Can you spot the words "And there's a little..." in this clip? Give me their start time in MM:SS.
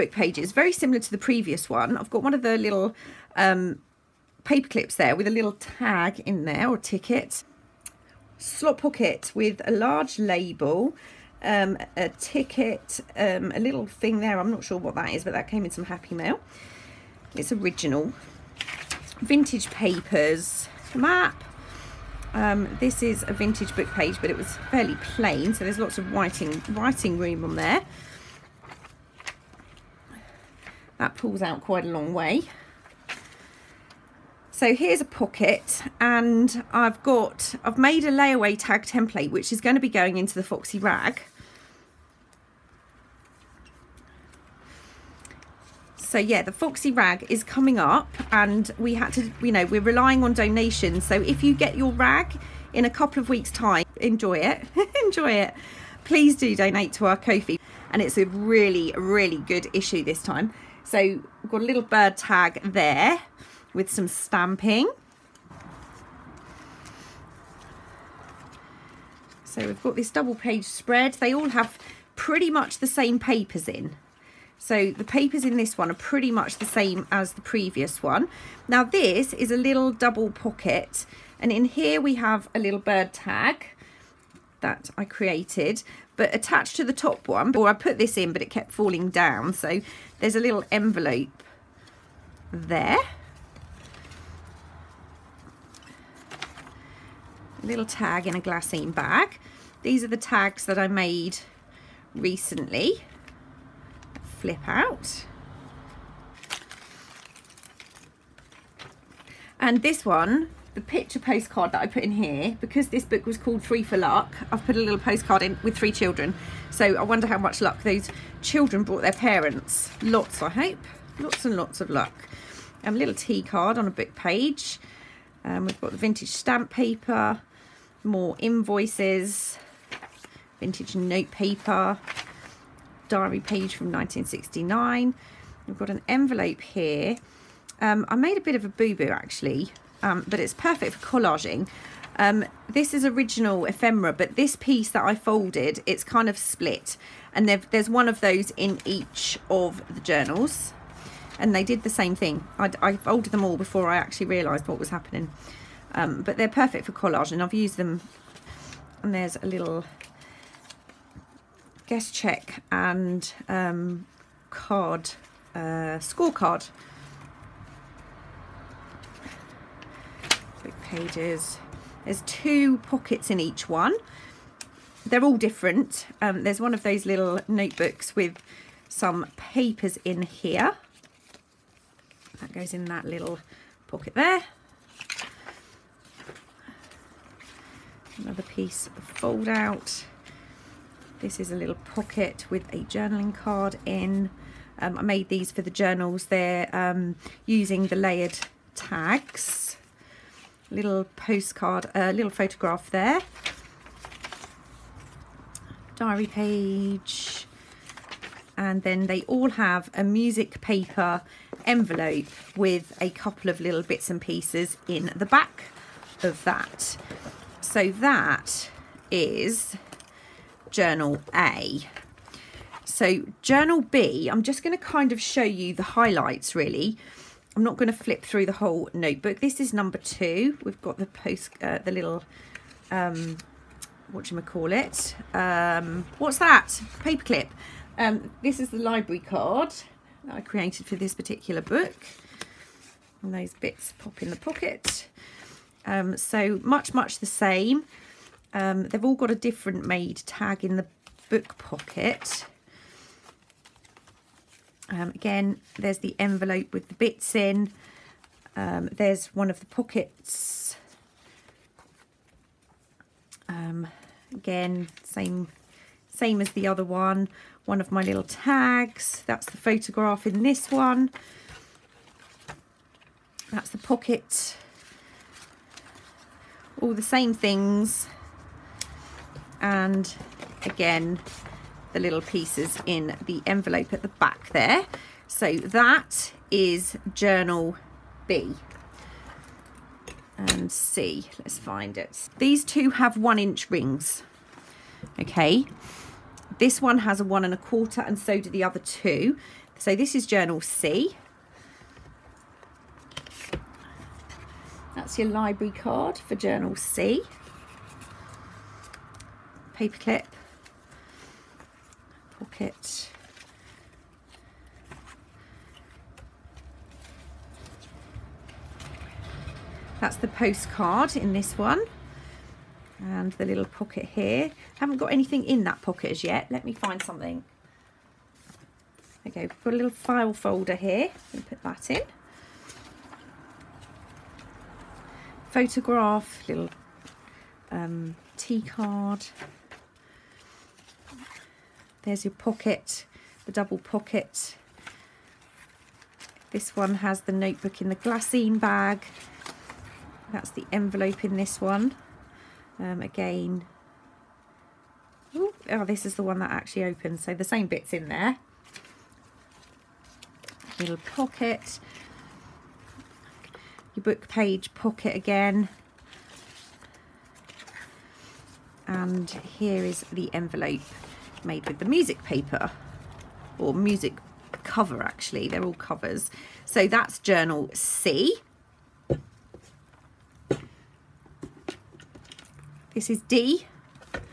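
02:39.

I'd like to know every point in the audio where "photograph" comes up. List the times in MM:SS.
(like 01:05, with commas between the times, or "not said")
03:22, 04:29, 05:35.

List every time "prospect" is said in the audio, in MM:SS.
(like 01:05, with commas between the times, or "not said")
not said.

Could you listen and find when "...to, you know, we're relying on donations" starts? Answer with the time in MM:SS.
00:49.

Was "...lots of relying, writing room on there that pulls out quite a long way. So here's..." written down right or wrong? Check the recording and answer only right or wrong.
wrong.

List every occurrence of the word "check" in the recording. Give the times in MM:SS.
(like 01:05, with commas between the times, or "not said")
02:42.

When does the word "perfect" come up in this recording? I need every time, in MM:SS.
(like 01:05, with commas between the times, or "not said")
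02:20, 02:36.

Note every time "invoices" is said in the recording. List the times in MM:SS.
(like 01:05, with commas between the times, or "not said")
02:08.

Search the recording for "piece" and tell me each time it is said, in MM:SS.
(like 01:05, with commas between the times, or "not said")
02:24, 03:08, 03:34, 04:42.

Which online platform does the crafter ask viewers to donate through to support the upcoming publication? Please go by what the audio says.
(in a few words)
Ko-fi.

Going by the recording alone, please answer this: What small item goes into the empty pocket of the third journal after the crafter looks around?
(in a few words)
file folder.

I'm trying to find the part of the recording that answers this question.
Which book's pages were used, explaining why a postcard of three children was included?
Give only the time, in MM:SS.
01:53.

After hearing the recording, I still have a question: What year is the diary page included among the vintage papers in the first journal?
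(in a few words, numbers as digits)
1969.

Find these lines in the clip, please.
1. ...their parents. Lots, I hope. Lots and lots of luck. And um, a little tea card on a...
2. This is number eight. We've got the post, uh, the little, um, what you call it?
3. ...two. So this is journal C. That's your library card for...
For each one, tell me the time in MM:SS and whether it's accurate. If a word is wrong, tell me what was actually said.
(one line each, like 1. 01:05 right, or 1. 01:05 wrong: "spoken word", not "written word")
1. 01:59 right
2. 03:49 wrong: "two", not "eight"
3. 04:58 right.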